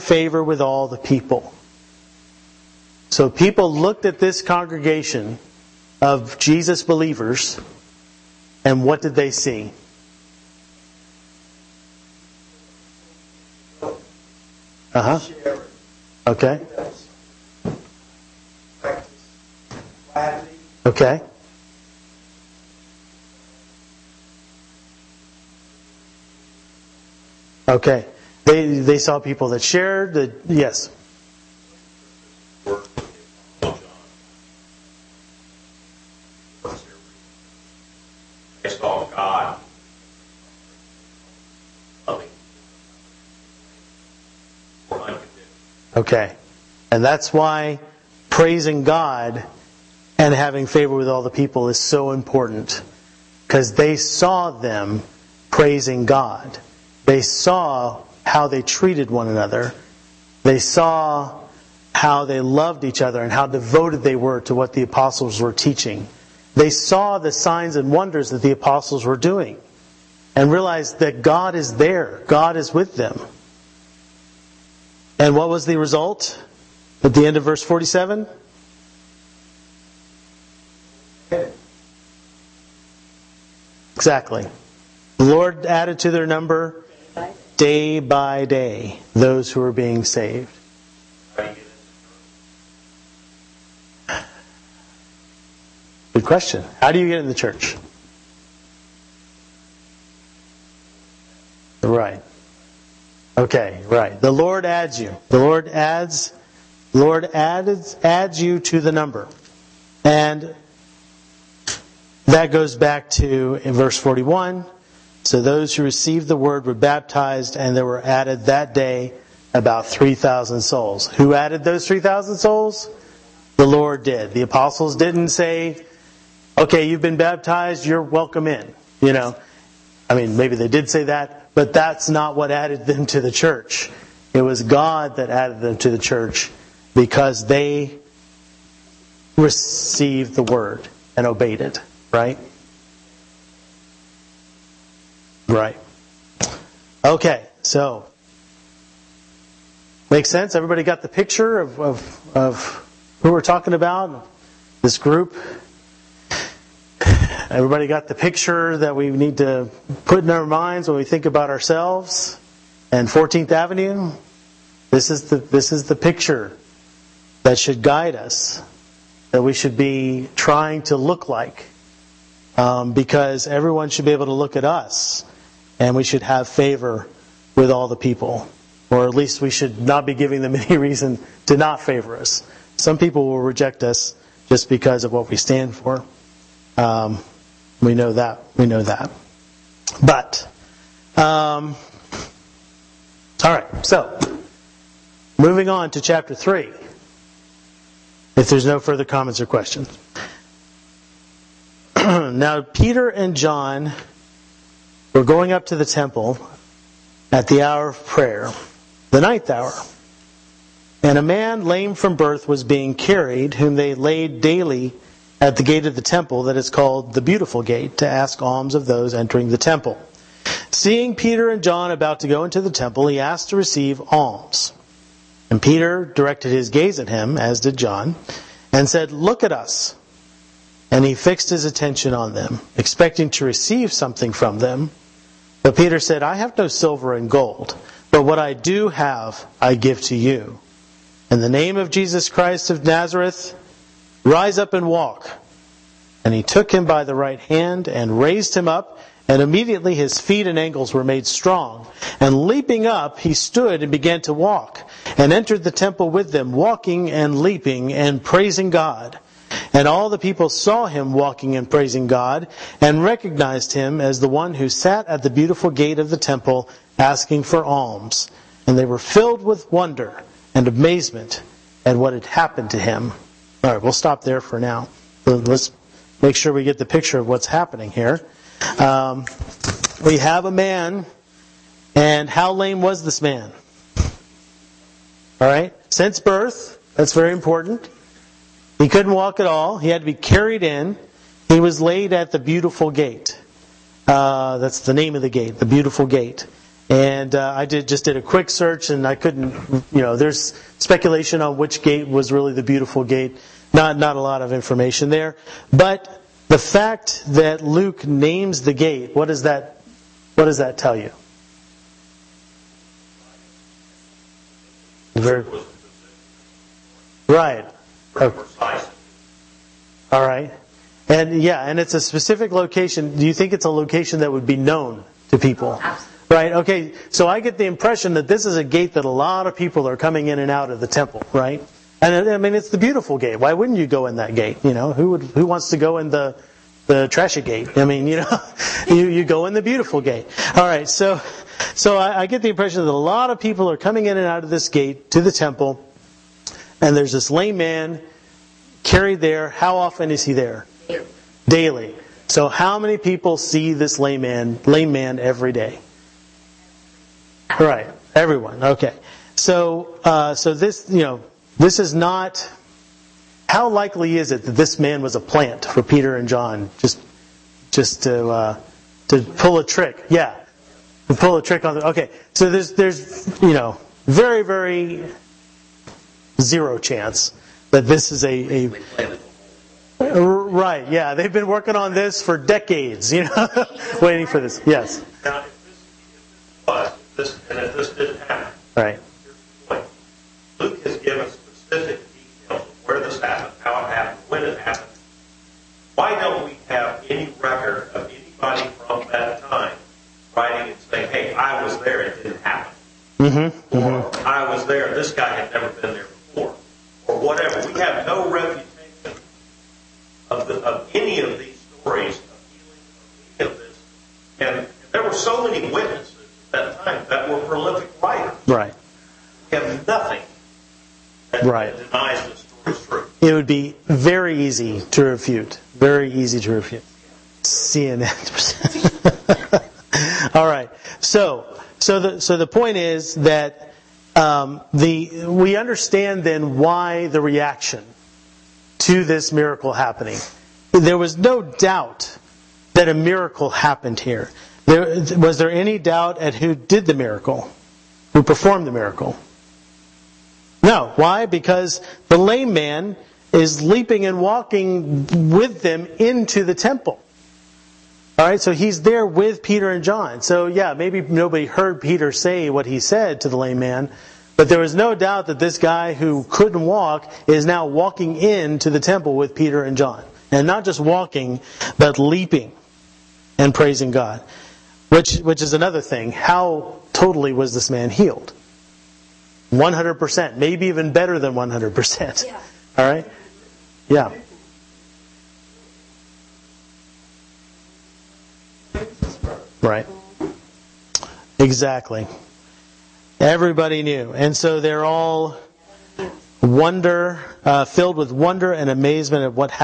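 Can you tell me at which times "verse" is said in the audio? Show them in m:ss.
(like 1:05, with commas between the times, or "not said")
1:17, 1:53.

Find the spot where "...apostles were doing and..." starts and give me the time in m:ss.
1:08.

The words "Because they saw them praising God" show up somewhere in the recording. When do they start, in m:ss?
0:53.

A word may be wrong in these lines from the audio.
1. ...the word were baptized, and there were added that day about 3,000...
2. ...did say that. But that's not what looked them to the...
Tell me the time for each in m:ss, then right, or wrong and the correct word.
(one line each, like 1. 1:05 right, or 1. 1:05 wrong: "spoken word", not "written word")
1. 1:56 right
2. 2:10 wrong: "added", not "looked".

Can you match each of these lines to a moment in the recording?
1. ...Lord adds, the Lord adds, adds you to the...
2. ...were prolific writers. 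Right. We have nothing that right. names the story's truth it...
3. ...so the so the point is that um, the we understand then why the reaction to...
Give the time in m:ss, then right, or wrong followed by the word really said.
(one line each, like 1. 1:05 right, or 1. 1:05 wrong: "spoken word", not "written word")
1. 1:45 right
2. 6:57 wrong: "denies", not "names"
3. 7:11 right.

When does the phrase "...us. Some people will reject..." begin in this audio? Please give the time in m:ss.
3:02.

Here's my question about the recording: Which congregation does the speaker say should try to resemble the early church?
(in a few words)
14th Avenue.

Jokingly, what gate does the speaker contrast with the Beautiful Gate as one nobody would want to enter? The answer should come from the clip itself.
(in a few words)
the trashy gate.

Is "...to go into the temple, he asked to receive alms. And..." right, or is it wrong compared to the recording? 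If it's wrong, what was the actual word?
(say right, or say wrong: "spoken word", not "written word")
right.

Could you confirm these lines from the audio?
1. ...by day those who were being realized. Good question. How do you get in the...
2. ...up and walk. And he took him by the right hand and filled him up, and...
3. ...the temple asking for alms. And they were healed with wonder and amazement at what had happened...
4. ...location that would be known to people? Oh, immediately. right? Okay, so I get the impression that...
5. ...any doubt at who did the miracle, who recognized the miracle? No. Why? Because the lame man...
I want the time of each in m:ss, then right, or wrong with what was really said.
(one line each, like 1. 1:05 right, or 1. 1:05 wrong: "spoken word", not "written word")
1. 1:27 wrong: "saved", not "realized"
2. 4:04 wrong: "raised", not "filled"
3. 4:26 wrong: "filled", not "healed"
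4. 5:23 wrong: "absolutely", not "immediately"
5. 7:25 wrong: "performed", not "recognized".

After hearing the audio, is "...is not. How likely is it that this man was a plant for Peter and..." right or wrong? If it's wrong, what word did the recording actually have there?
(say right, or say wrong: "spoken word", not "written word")
right.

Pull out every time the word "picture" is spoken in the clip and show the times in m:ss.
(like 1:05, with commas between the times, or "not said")
2:31, 2:38, 2:45, 4:36.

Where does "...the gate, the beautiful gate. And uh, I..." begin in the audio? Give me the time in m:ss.
4:55.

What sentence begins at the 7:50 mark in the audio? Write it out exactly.
And not just walking, but leaping and praising God.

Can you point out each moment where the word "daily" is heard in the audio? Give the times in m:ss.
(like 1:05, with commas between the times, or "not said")
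3:34, 5:51.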